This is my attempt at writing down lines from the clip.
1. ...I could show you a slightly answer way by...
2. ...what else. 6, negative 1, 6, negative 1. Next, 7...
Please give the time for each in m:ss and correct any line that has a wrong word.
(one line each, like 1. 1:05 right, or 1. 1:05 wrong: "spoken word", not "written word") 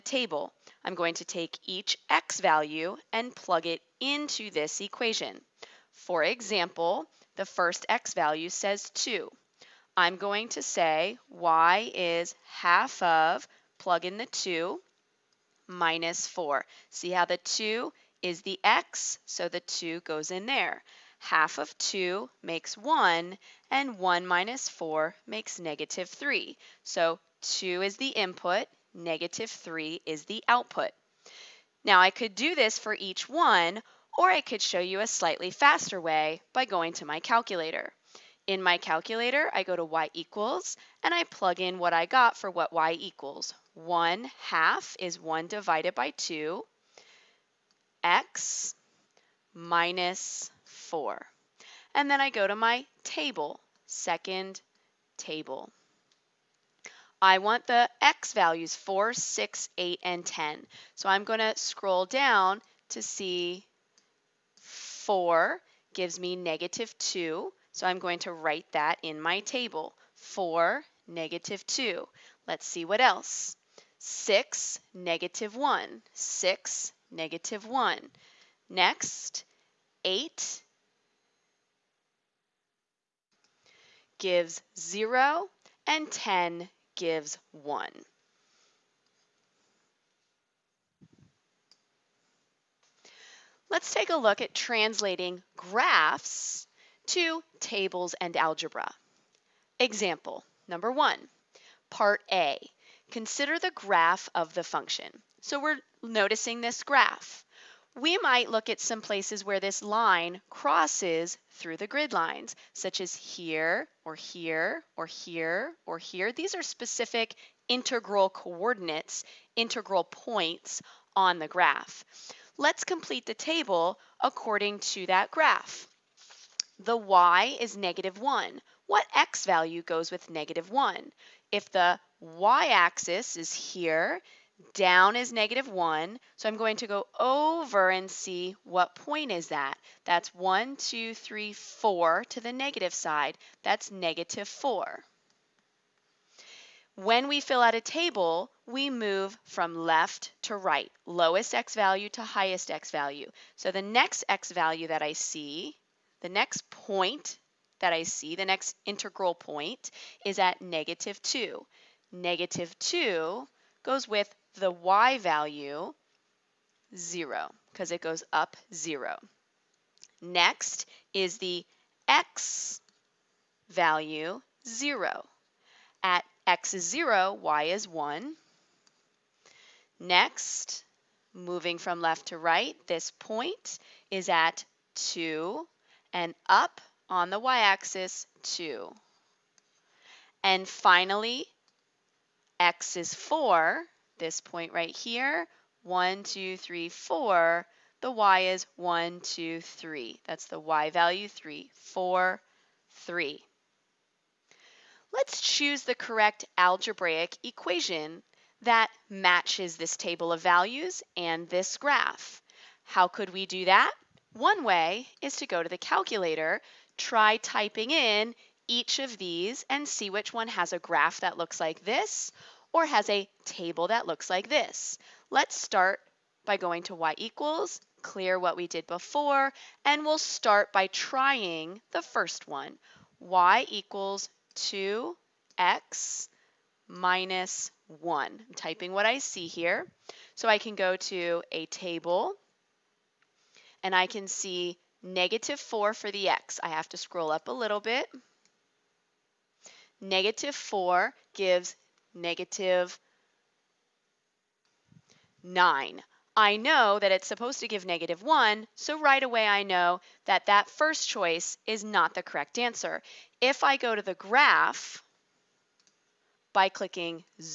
1. 0:34 wrong: "faster", not "answer"
2. 1:12 wrong: "8", not "7".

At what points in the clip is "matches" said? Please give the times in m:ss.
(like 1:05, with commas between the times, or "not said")
3:29.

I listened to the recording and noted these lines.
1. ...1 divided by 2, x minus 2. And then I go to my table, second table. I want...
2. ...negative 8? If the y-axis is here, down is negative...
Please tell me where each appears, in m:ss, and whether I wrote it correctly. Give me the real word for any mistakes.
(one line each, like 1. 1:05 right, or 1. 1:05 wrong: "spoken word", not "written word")
1. 0:45 wrong: "4", not "2"
2. 2:10 wrong: "1", not "8".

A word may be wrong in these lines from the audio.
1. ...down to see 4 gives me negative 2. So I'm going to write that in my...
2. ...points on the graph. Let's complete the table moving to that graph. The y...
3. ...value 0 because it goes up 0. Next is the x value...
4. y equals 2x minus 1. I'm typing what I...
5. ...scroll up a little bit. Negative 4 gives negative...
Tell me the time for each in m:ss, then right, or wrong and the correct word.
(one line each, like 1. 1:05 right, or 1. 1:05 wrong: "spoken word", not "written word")
1. 1:02 right
2. 2:00 wrong: "according", not "moving"
3. 2:45 right
4. 3:53 right
5. 4:06 right.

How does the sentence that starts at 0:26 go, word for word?
So 2 is the input, negative 3 is the output.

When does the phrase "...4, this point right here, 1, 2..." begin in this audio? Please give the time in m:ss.
3:13.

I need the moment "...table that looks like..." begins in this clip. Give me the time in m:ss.
3:43.